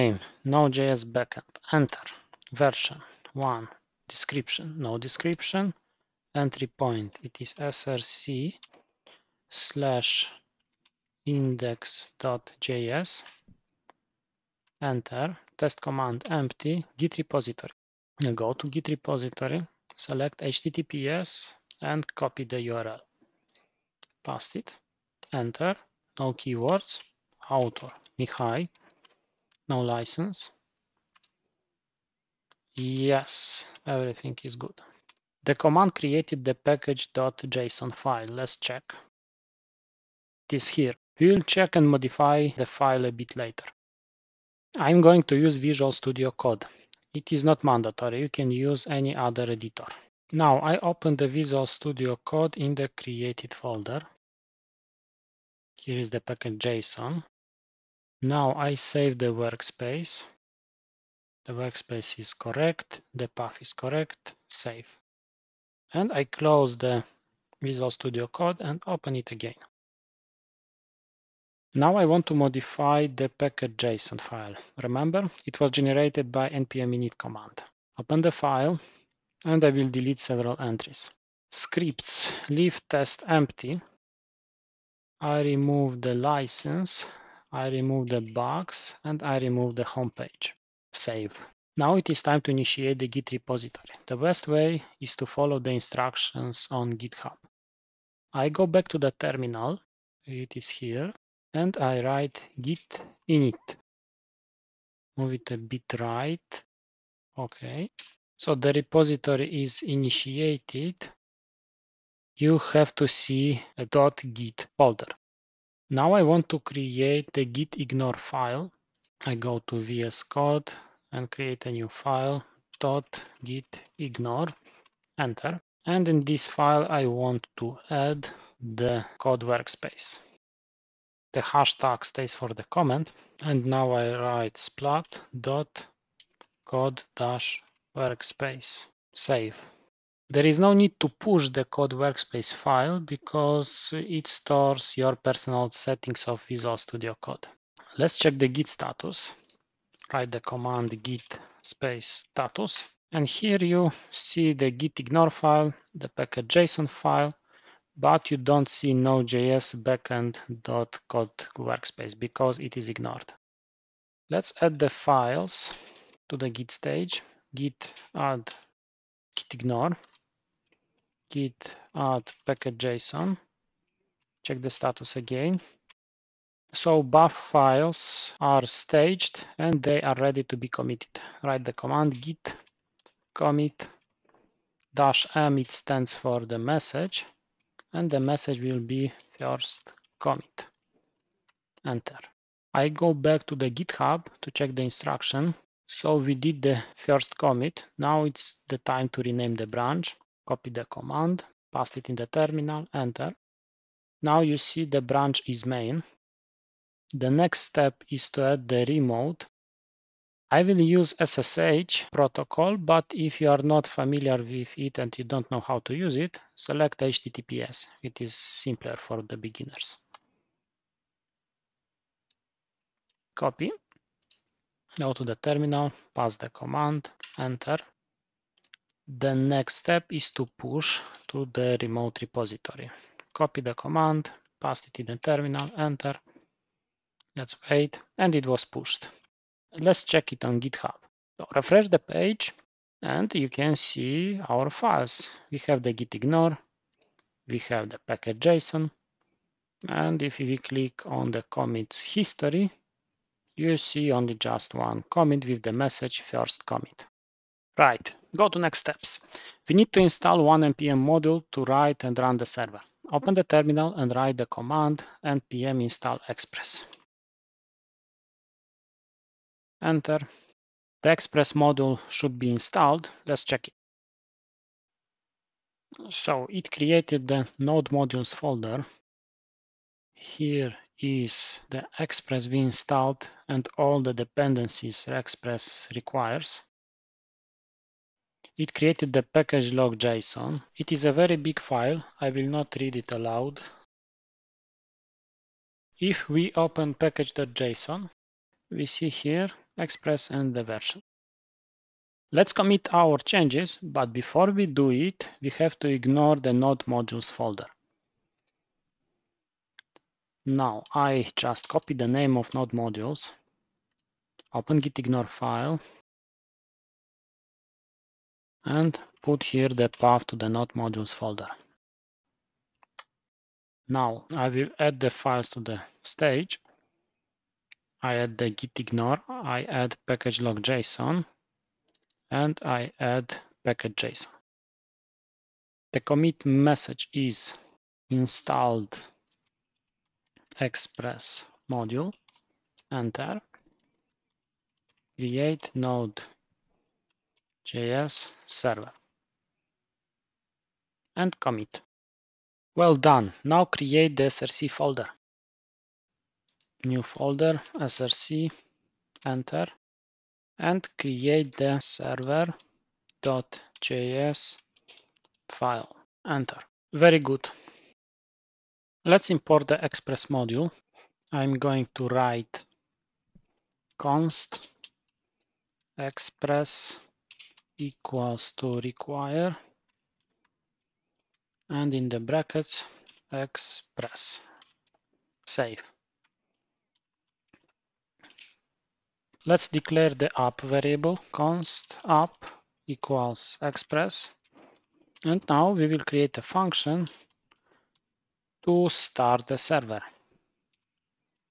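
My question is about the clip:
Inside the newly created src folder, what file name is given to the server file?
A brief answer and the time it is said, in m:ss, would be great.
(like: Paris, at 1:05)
server.js, at 6:01.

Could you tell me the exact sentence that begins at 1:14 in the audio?
Remember, it was generated by npm init command.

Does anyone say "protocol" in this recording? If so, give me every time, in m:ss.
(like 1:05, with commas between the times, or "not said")
3:32.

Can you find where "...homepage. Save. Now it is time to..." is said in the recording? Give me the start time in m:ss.
1:29.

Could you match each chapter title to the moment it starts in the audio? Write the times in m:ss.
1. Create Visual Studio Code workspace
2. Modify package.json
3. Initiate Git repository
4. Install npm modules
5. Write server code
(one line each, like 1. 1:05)
1. 0:44
2. 1:11
3. 1:31
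4. 4:17
5. 5:52.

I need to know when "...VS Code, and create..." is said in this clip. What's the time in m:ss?
1:59.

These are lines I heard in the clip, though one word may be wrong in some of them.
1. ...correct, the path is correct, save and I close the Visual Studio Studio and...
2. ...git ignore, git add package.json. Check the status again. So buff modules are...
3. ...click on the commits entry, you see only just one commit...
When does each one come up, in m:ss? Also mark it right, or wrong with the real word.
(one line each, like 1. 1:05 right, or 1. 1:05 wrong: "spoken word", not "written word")
1. 1:02 wrong: "Code", not "Studio"
2. 2:49 wrong: "files", not "modules"
3. 4:10 wrong: "history", not "entry".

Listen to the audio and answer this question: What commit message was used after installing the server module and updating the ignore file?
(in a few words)
installed express module.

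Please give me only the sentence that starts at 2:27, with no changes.
Let's check the git status write the command git space status.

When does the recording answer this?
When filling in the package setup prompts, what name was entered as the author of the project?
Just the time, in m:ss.
0:28.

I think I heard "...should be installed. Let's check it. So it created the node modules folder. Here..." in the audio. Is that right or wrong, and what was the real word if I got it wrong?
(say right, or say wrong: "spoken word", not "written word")
right.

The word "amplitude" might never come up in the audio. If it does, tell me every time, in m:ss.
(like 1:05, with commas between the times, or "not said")
not said.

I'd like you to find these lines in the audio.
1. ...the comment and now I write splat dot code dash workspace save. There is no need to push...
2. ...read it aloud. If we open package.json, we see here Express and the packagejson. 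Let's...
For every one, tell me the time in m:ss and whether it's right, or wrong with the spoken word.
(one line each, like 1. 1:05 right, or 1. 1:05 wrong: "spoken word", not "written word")
1. 2:12 right
2. 4:52 wrong: "version", not "packagejson".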